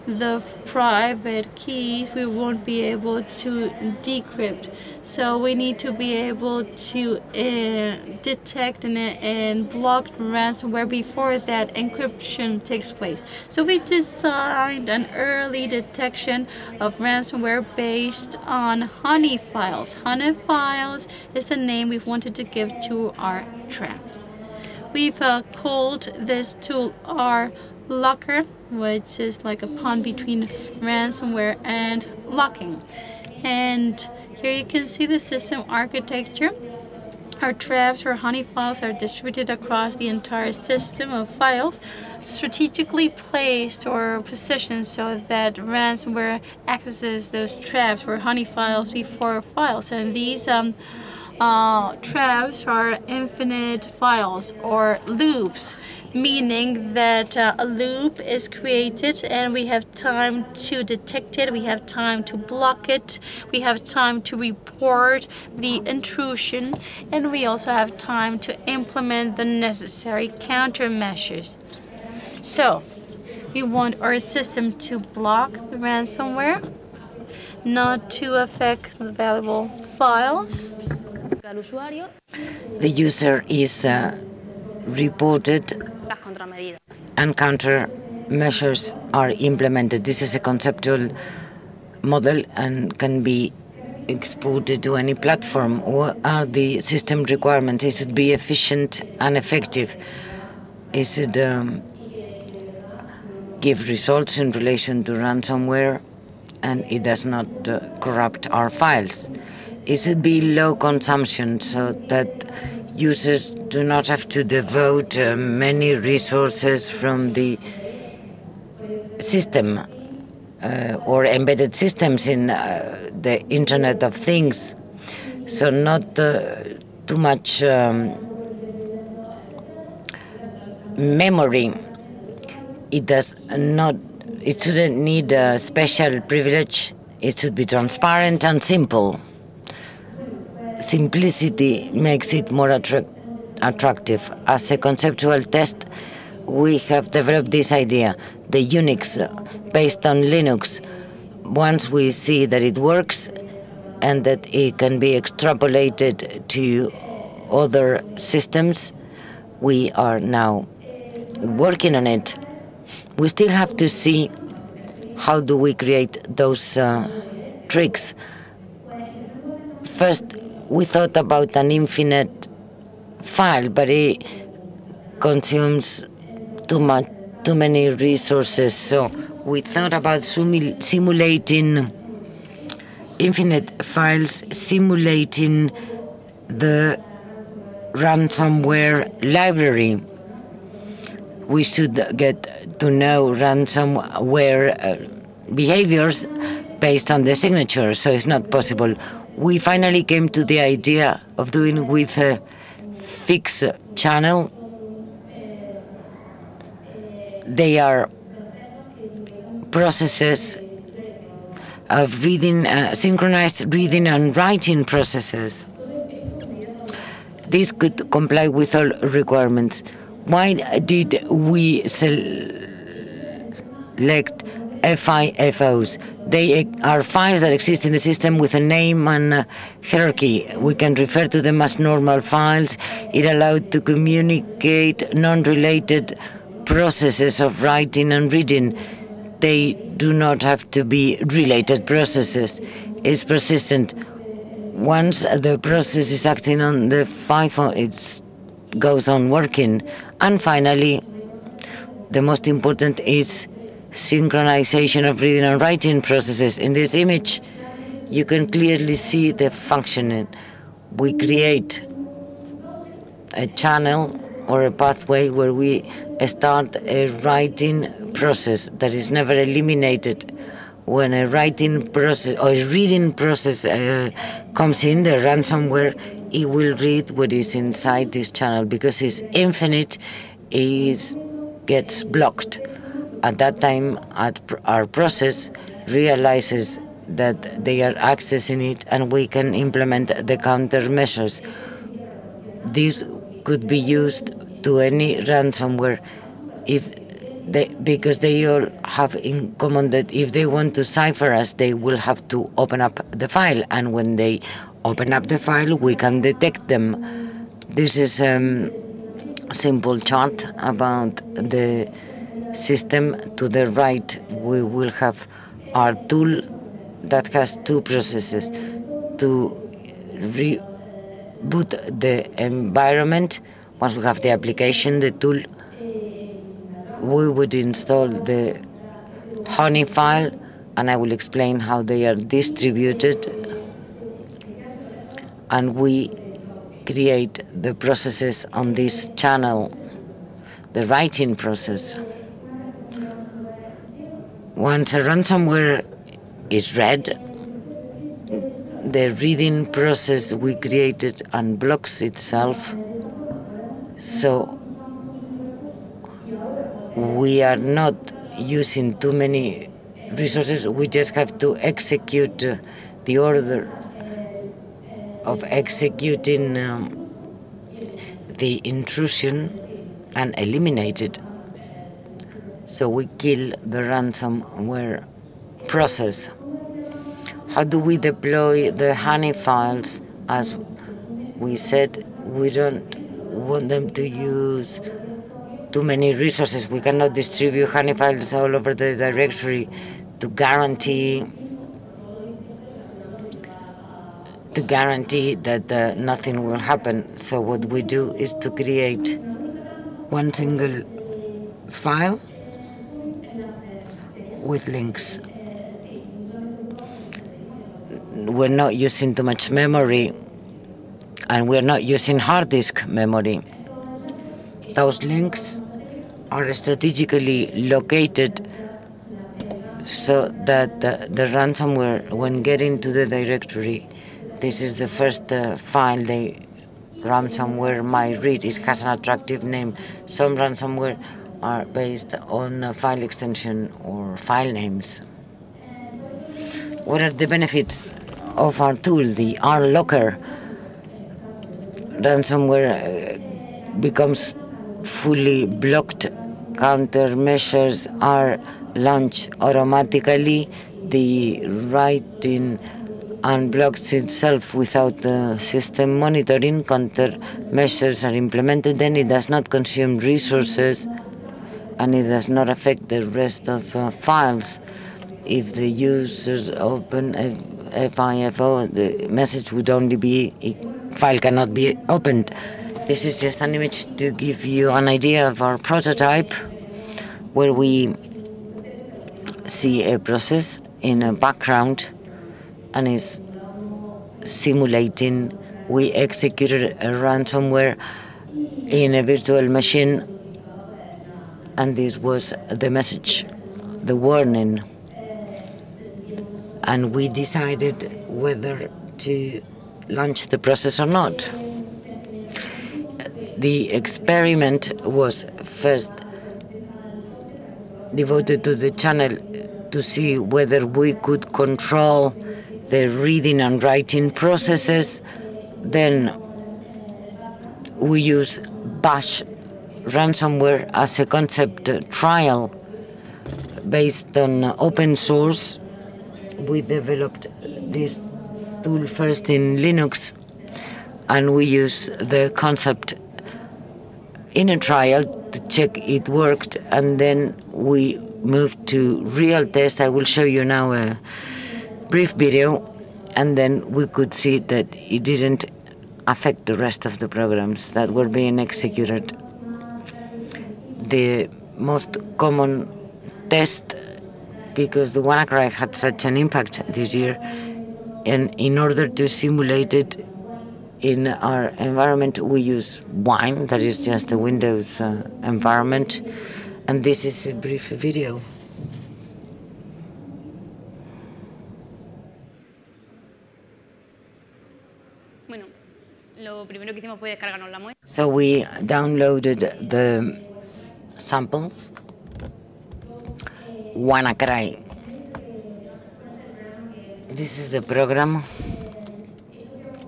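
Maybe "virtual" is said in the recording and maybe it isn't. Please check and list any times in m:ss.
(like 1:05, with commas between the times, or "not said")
8:09.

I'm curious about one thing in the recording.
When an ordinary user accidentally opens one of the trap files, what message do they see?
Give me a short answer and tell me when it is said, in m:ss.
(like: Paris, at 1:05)
File cannot be opened, at 7:50.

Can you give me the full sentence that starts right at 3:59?
They do not have to be related processes.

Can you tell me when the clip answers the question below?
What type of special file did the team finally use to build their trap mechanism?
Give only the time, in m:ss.
3:44.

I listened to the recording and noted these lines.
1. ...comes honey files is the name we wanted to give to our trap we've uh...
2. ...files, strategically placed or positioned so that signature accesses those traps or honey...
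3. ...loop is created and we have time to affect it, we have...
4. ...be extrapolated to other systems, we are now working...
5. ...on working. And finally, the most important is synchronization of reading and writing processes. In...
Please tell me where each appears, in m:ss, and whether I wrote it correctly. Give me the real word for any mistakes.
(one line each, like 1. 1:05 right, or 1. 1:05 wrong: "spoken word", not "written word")
1. 0:19 wrong: "files", not "comes"
2. 0:41 wrong: "ransomware", not "signature"
3. 0:57 wrong: "detect", not "affect"
4. 2:34 right
5. 4:09 right.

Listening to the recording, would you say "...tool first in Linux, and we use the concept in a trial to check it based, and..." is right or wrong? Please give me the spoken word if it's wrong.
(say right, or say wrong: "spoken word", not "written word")
wrong: "worked", not "based".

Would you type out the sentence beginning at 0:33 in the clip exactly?
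And here you can see the system architecture.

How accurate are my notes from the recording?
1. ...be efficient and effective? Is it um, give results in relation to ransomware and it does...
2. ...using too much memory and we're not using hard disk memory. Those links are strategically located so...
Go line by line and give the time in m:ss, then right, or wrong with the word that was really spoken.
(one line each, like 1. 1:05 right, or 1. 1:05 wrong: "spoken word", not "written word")
1. 1:38 right
2. 6:48 right.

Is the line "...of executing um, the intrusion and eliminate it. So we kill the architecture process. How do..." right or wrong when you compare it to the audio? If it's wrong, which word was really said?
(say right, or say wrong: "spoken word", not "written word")
wrong: "ransomware", not "architecture".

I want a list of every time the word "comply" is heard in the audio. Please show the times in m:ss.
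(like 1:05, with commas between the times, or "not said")
3:38.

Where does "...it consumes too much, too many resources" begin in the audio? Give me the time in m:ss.
2:53.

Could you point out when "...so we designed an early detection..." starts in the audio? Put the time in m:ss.
0:13.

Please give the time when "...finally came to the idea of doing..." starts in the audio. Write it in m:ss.
3:19.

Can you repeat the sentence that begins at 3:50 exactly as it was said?
We can refer to them as normal files.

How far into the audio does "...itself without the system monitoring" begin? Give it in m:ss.
7:33.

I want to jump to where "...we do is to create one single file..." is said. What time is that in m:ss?
6:37.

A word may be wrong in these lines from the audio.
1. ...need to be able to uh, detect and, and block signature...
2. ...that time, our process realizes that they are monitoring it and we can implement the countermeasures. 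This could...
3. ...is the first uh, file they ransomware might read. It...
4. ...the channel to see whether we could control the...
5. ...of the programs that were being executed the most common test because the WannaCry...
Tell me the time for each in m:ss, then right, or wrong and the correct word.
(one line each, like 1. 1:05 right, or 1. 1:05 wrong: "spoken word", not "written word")
1. 0:05 wrong: "ransomware", not "signature"
2. 4:43 wrong: "accessing", not "monitoring"
3. 7:04 right
4. 8:28 right
5. 9:06 right.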